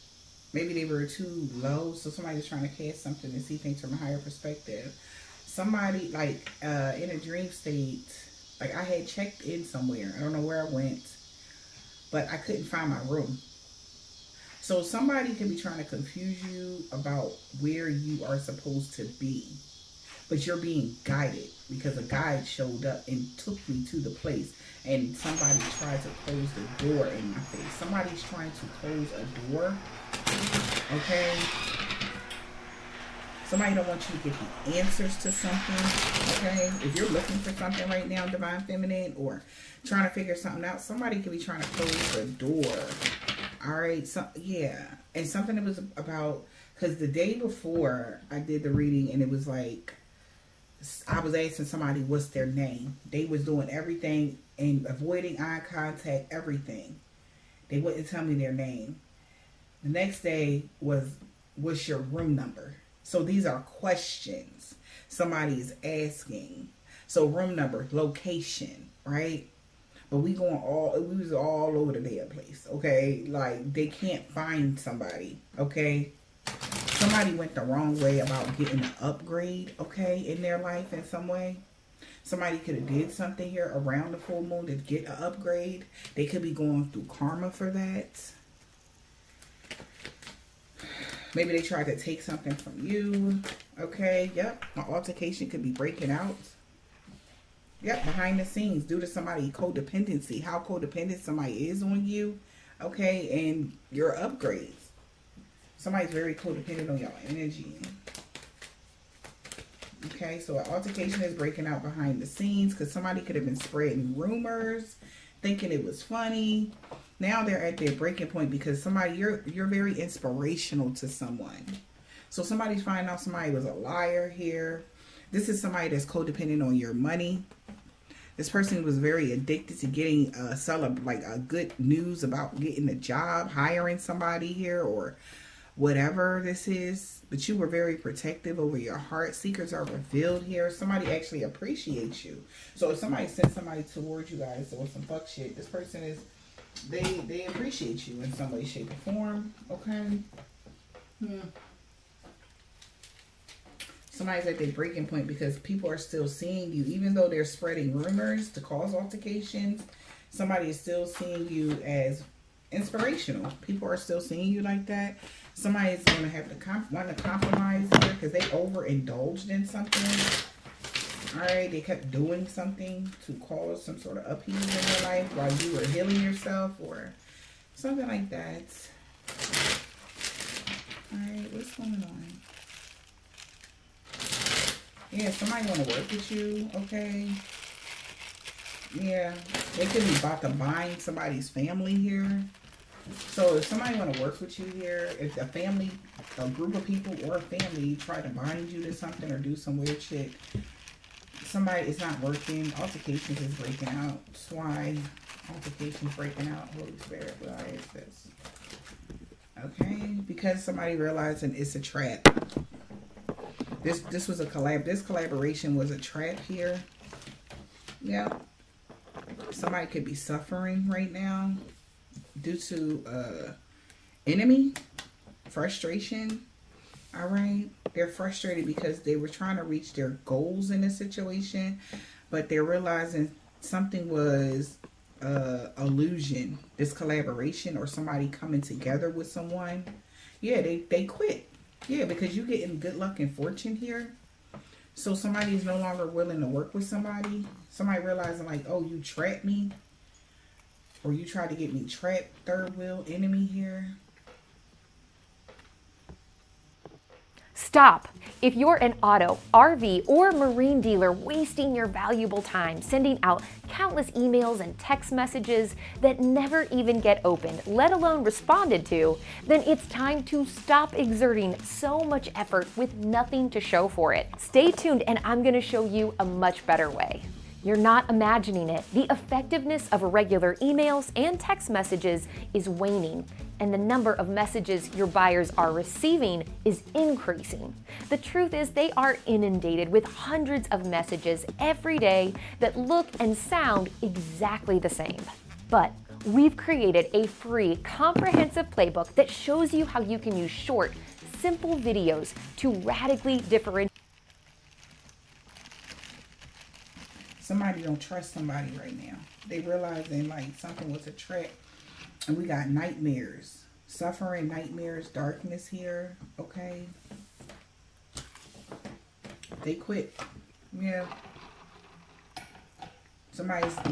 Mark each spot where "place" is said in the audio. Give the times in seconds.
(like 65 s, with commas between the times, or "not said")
24 s, 72 s.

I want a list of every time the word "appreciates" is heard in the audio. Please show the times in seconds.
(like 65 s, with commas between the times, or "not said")
141 s, 147 s.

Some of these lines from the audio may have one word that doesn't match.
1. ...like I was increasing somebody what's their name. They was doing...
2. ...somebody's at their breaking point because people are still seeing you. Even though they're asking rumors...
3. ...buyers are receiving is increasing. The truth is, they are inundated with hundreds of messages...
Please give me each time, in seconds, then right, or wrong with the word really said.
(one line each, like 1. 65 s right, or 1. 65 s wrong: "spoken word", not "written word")
1. 49 s wrong: "asking", not "increasing"
2. 154 s wrong: "spreading", not "asking"
3. 285 s right.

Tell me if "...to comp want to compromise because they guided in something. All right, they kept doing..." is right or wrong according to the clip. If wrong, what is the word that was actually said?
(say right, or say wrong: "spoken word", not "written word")
wrong: "overindulged", not "guided".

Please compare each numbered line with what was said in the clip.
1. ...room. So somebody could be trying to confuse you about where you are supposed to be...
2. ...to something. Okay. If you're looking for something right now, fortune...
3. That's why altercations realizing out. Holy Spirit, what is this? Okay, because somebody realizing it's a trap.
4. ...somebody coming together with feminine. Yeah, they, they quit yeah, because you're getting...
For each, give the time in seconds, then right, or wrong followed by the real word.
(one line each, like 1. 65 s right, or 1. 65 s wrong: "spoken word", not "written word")
1. 13 s right
2. 35 s wrong: "divine", not "fortune"
3. 204 s wrong: "breaking", not "realizing"
4. 237 s wrong: "someone", not "feminine".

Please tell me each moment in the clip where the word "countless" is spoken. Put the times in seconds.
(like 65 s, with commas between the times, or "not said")
263 s.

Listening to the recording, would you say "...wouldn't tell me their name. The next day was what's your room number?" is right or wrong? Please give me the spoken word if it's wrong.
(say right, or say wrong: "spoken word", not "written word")
right.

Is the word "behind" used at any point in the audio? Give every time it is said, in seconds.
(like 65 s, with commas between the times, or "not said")
98 s, 111 s.